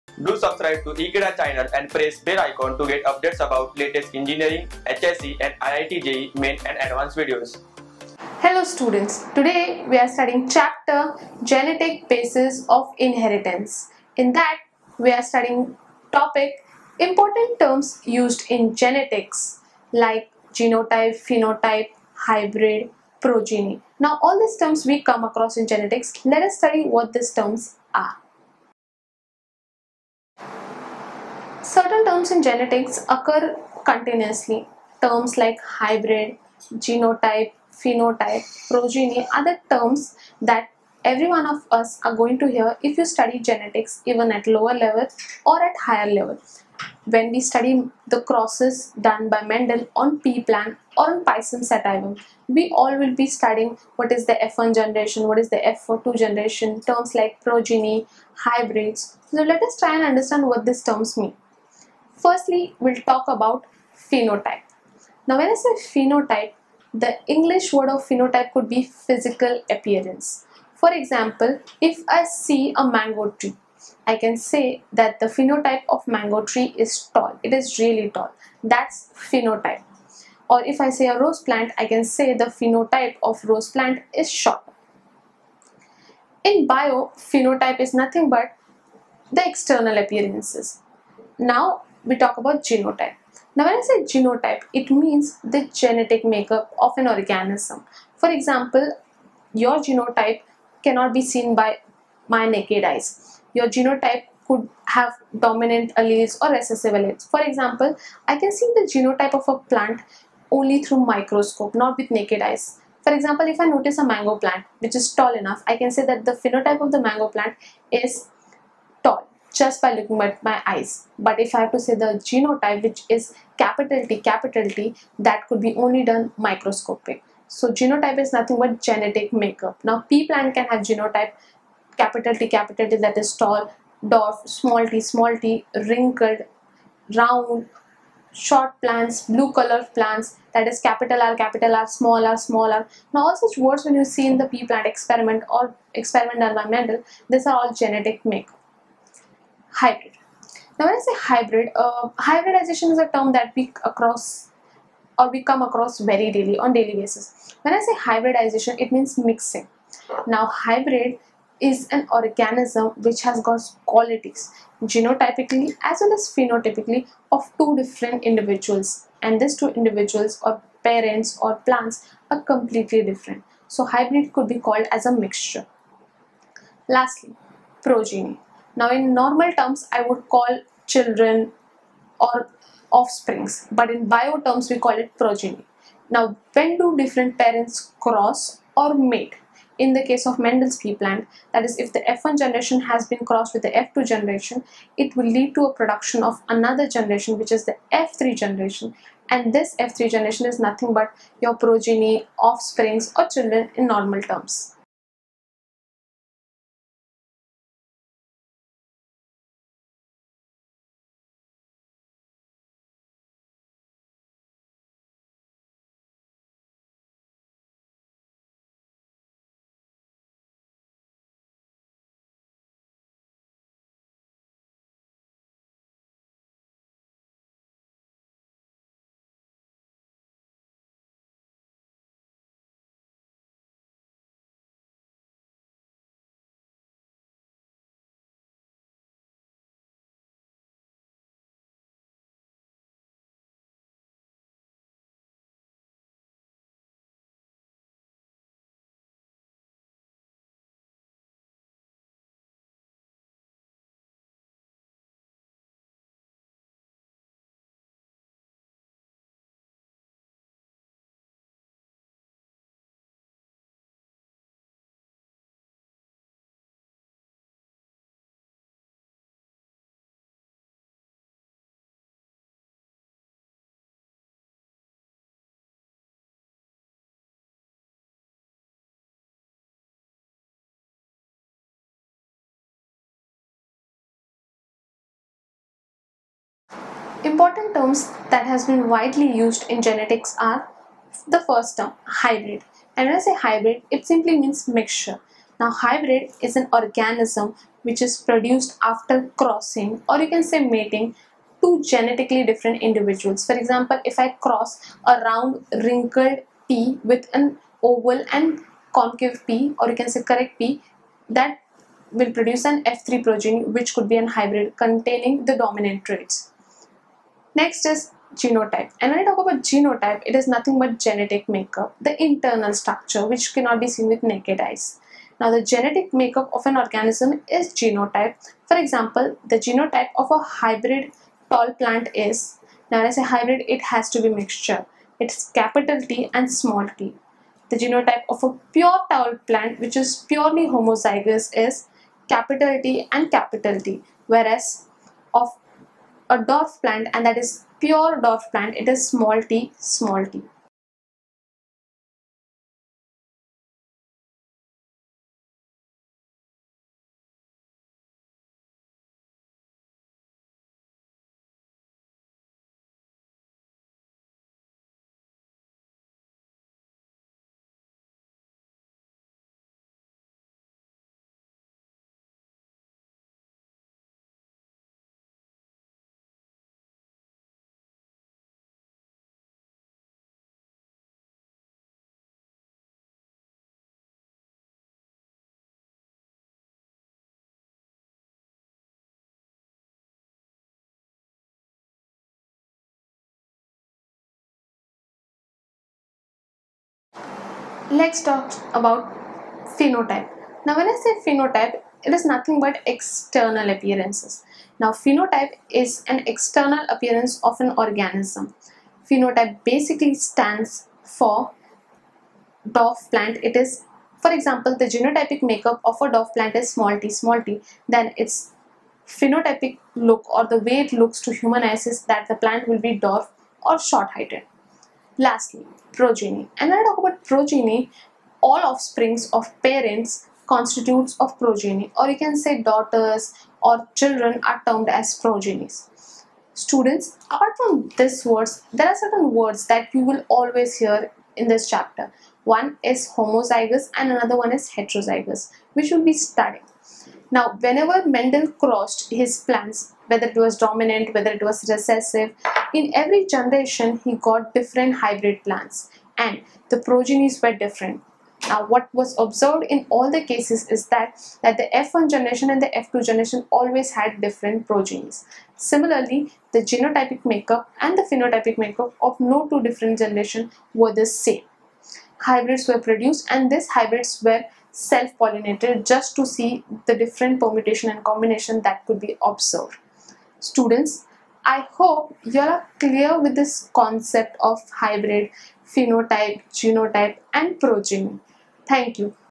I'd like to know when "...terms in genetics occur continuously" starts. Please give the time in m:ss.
0:32.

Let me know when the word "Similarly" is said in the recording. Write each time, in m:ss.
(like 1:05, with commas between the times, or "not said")
7:45.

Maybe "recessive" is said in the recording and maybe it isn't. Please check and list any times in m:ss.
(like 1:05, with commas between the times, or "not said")
1:46, 7:31.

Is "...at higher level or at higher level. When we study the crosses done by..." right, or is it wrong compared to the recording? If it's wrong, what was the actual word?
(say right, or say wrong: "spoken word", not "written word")
wrong: "lower", not "higher".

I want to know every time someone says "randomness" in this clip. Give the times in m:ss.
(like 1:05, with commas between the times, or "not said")
not said.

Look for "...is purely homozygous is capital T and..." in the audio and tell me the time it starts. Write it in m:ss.
5:39.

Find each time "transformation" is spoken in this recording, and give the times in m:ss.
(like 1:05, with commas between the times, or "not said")
not said.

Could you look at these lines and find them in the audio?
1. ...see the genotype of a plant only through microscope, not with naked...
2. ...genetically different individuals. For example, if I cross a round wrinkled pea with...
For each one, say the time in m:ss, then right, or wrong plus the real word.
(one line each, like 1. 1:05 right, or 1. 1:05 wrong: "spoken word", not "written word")
1. 1:48 right
2. 5:01 right.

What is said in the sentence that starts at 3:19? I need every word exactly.
And this F3 generation is nothing but your progeny, offsprings, or children in normal terms.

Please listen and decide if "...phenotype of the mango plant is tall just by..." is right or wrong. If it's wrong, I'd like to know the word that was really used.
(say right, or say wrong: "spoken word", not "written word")
right.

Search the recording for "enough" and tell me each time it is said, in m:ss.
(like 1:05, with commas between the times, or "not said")
1:55.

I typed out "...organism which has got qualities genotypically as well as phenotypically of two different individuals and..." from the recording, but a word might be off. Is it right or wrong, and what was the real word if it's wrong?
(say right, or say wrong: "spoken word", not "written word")
right.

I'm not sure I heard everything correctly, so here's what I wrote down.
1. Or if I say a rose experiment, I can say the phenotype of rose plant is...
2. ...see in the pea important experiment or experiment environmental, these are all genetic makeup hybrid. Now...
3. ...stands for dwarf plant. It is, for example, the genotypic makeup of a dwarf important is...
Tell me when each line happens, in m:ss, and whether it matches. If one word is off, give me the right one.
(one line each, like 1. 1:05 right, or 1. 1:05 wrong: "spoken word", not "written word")
1. 1:20 wrong: "plant", not "experiment"
2. 2:24 wrong: "plant", not "important"
3. 6:50 wrong: "plant", not "important".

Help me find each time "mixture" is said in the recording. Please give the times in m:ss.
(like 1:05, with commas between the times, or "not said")
2:55, 4:54, 5:34.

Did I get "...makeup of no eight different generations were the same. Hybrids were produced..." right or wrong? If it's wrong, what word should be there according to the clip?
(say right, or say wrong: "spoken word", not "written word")
wrong: "two", not "eight".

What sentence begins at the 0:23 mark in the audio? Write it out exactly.
Now all these terms we come across in genetics.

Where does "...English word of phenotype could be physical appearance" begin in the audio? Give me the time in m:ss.
1:07.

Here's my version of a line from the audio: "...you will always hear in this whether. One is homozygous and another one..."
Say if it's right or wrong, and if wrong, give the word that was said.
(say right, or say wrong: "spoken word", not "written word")
wrong: "chapter", not "whether".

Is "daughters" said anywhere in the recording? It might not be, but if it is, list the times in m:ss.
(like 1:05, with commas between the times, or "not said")
7:12.